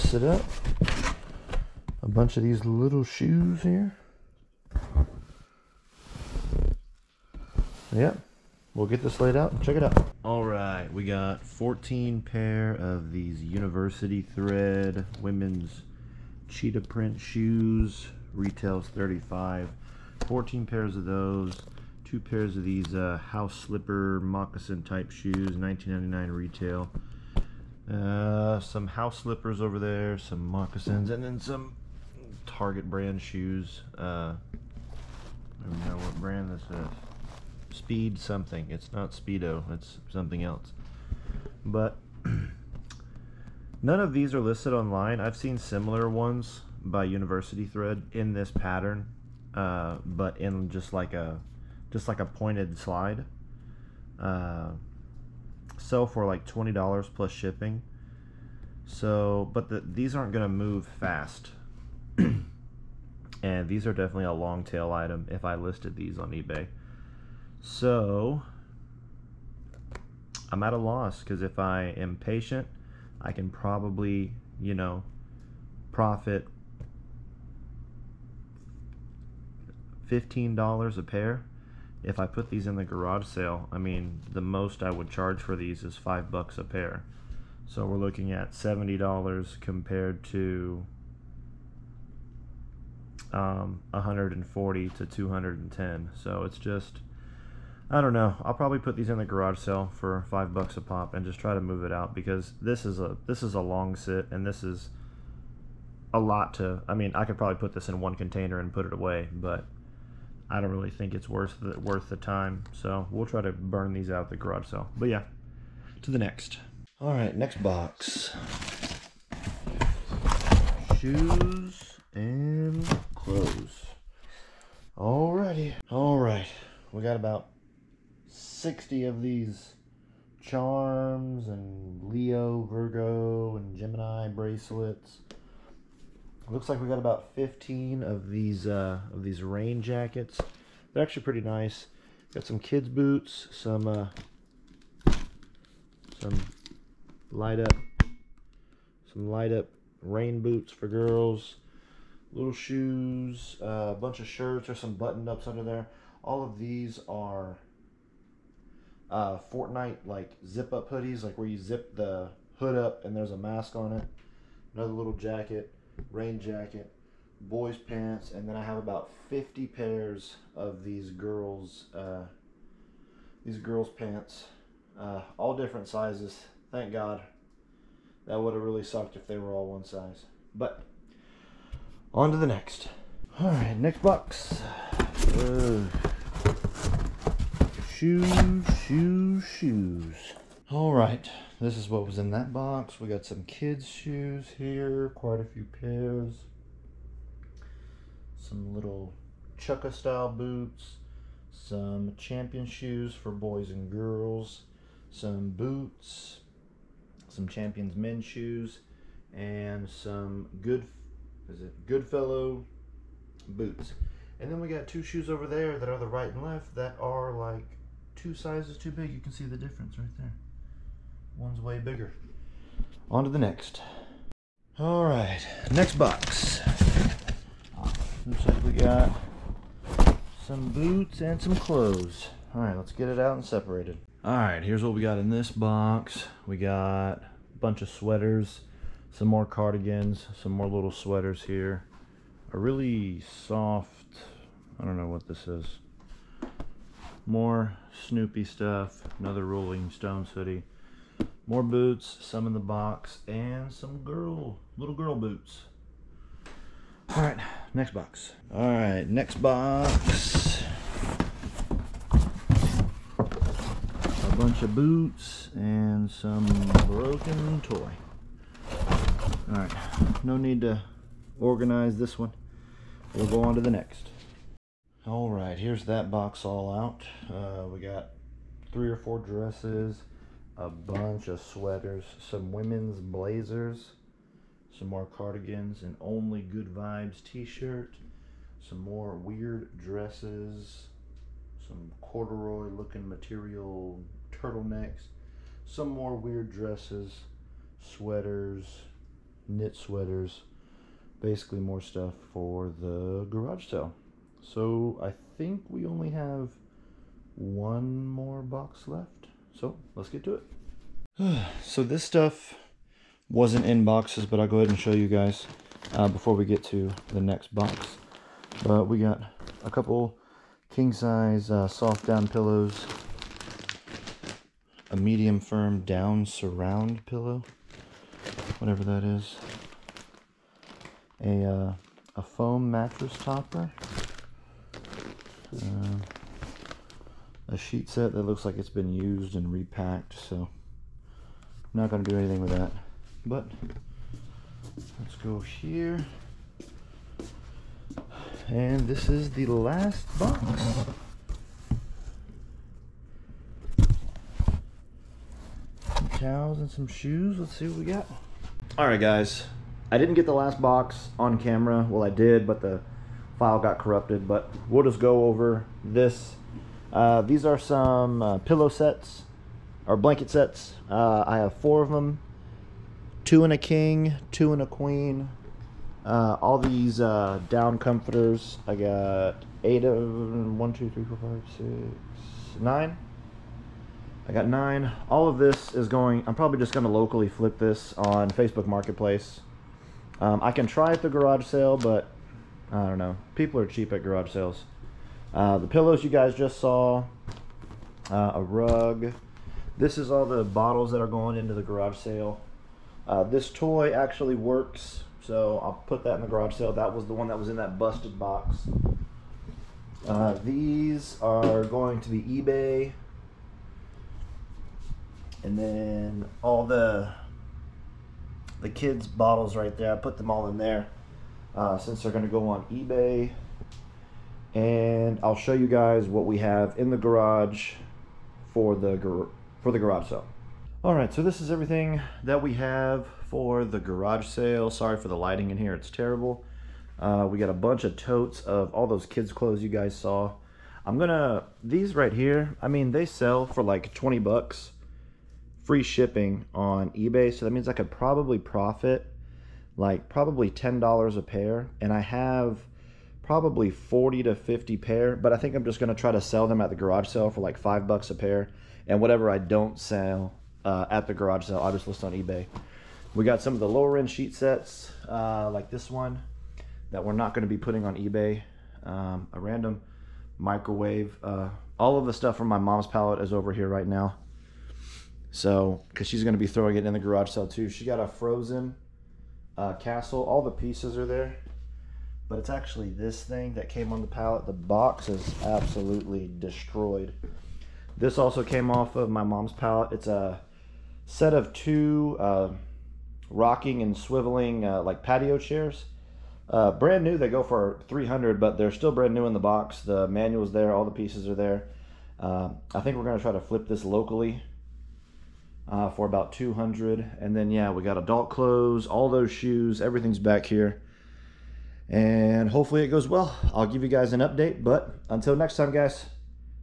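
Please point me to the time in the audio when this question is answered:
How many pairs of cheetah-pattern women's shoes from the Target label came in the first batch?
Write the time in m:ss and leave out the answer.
0:11.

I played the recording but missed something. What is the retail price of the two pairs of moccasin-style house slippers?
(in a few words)
$19.99.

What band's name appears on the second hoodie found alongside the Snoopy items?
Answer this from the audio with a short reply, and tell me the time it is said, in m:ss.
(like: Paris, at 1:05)
Rolling Stones, at 4:09.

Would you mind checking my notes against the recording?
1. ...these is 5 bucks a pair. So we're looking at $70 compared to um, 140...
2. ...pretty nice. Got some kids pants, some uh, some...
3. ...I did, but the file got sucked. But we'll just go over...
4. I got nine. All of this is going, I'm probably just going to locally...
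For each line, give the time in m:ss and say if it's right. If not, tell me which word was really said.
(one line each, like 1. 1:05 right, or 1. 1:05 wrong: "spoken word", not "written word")
1. 1:25 right
2. 2:21 wrong: "boots", not "pants"
3. 6:02 wrong: "corrupted", not "sucked"
4. 6:24 right.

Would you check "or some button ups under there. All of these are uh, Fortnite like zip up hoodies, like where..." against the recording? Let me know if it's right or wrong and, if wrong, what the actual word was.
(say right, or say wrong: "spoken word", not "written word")
right.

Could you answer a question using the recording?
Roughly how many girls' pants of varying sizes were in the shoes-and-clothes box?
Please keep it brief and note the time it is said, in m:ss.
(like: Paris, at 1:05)
50, at 2:49.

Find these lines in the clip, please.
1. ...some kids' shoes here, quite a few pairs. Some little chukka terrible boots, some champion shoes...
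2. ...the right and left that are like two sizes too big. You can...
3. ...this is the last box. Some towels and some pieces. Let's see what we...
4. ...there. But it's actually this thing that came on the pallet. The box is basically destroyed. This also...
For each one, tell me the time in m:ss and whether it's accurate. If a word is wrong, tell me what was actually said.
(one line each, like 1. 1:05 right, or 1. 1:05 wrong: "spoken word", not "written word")
1. 3:13 wrong: "style", not "terrible"
2. 3:35 right
3. 5:48 wrong: "shoes", not "pieces"
4. 8:01 wrong: "absolutely", not "basically".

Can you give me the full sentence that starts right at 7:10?
All right, so this is everything that we have for the garage sale.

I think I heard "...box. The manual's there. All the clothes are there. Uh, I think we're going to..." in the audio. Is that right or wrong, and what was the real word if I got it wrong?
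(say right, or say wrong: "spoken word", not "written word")
wrong: "pieces", not "clothes".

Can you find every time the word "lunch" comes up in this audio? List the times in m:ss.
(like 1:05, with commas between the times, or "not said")
not said.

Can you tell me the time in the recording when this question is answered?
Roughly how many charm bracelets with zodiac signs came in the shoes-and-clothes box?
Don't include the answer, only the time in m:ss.
2:08.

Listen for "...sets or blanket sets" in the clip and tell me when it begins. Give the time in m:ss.
6:08.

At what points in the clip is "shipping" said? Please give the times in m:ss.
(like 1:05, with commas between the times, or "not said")
0:57, 7:25.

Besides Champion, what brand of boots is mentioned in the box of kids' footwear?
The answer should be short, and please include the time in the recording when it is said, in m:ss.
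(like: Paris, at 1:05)
Goodfellow, at 3:31.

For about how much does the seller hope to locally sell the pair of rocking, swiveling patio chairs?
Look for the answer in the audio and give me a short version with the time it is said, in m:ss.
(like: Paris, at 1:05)
$200, at 8:26.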